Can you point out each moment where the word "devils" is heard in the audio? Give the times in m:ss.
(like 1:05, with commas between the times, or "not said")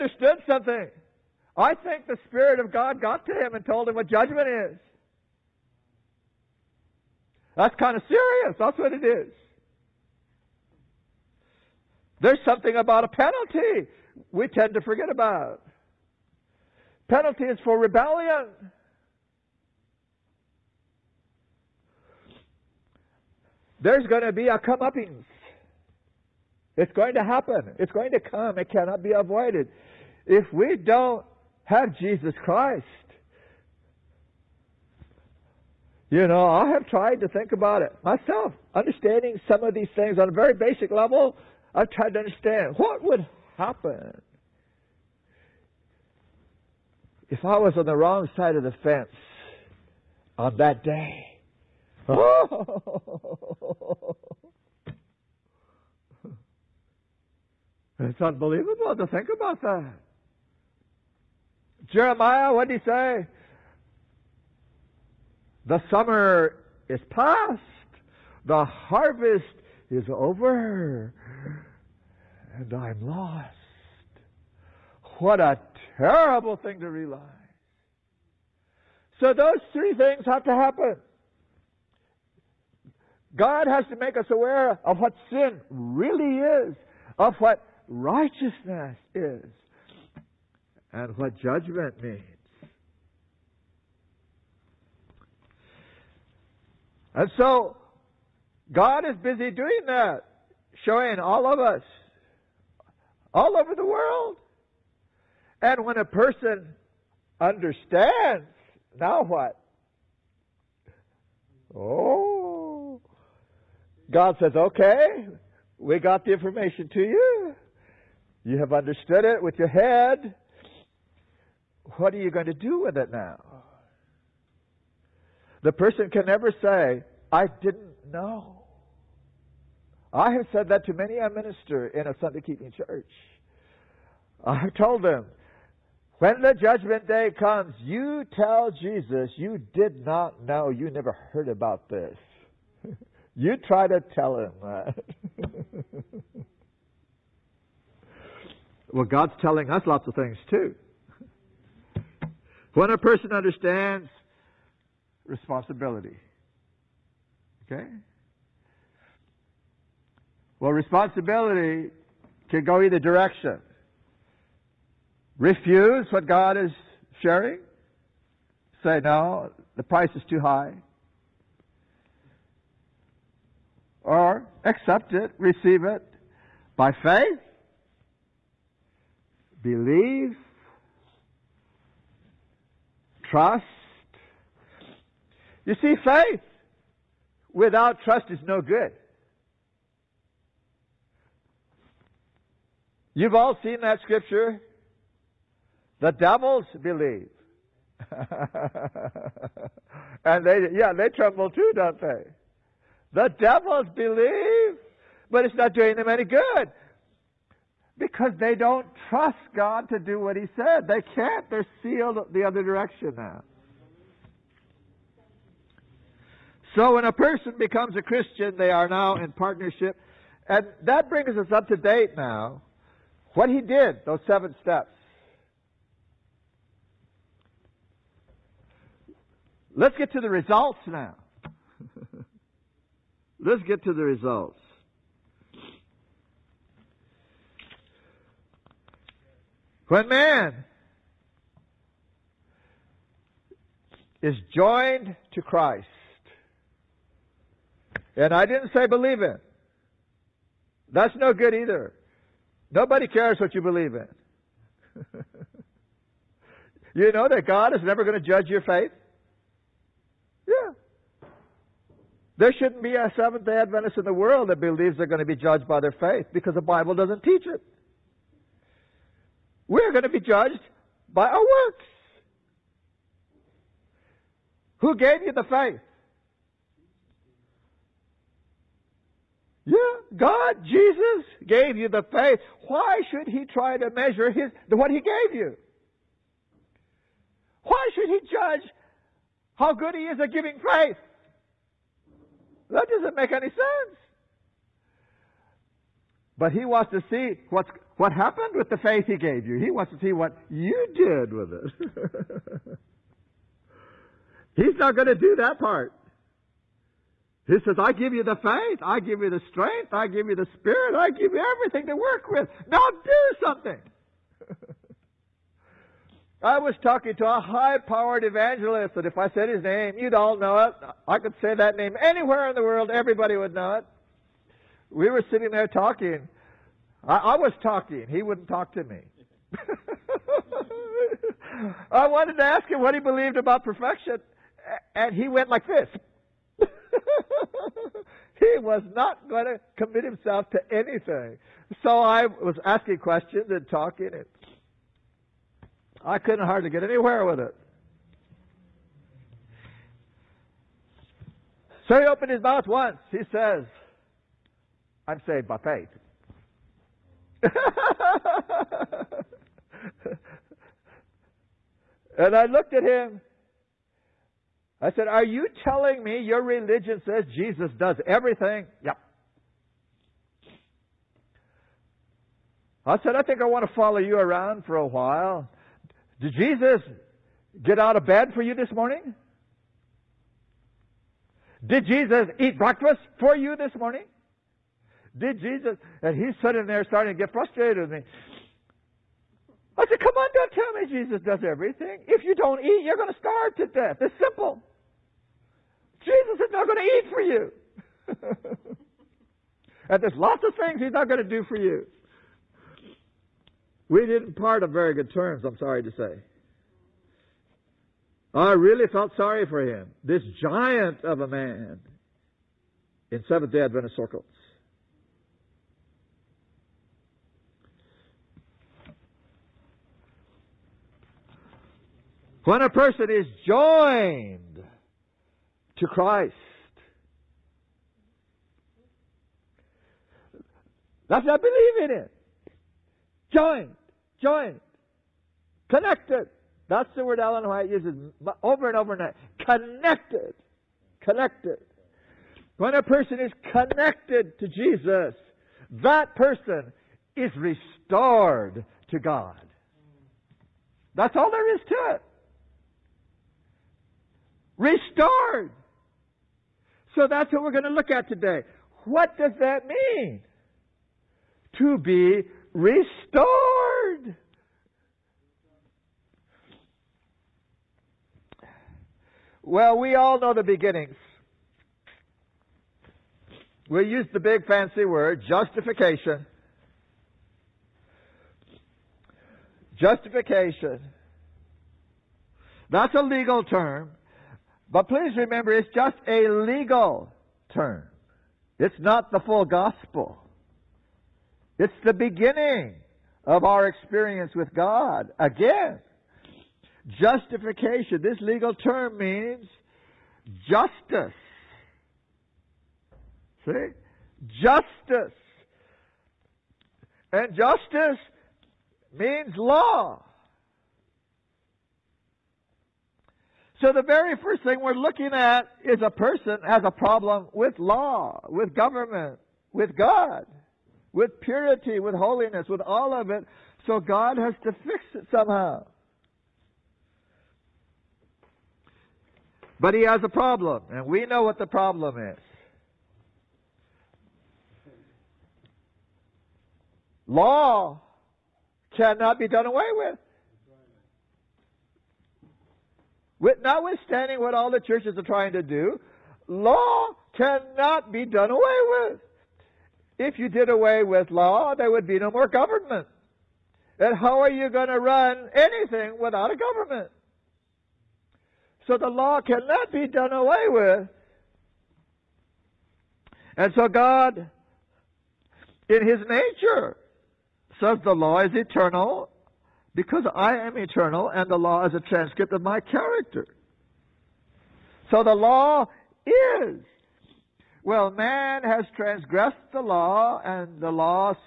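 3:16, 3:23.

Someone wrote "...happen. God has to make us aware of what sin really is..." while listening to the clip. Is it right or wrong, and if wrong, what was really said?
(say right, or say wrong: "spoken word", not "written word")
right.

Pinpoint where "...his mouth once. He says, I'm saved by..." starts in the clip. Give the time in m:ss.
5:52.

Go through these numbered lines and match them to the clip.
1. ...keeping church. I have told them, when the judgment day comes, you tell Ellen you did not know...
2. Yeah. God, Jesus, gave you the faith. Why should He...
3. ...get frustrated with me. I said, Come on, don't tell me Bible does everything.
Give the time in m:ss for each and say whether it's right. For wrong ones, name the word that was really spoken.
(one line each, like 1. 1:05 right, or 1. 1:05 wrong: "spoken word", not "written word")
1. 2:12 wrong: "Jesus", not "Ellen"
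2. 4:39 right
3. 6:27 wrong: "Jesus", not "Bible".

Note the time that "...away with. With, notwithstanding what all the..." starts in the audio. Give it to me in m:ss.
8:59.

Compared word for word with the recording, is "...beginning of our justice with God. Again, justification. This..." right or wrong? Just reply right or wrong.
wrong.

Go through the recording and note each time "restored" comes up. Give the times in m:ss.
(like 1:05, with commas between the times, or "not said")
7:27, 7:34, 7:42.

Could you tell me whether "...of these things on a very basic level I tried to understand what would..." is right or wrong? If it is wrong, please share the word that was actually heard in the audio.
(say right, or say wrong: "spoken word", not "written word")
right.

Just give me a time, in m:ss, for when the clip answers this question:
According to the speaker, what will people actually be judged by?
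4:31.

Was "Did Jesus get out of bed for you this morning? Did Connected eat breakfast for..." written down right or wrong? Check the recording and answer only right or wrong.
wrong.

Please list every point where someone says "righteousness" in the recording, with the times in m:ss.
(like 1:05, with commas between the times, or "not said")
1:27.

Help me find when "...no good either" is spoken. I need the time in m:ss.
4:11.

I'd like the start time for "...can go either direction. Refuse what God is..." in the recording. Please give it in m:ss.
2:42.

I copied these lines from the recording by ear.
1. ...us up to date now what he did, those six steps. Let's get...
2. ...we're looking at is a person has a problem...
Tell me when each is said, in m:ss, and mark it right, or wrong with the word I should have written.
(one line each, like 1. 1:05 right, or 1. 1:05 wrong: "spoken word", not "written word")
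1. 3:41 wrong: "seven", not "six"
2. 8:34 right.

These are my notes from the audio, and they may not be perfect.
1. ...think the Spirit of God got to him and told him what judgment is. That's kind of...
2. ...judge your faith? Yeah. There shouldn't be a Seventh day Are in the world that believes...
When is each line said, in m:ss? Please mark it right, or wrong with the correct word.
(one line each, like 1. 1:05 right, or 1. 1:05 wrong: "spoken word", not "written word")
1. 0:01 right
2. 4:18 wrong: "Adventist", not "Are".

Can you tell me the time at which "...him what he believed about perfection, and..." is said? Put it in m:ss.
5:32.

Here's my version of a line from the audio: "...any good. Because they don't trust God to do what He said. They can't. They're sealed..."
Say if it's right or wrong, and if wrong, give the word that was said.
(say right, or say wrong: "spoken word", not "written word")
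right.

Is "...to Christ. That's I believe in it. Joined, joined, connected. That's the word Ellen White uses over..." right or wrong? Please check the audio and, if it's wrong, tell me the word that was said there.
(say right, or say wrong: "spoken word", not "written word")
right.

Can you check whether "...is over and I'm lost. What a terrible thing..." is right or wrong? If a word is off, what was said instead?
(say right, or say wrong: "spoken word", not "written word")
right.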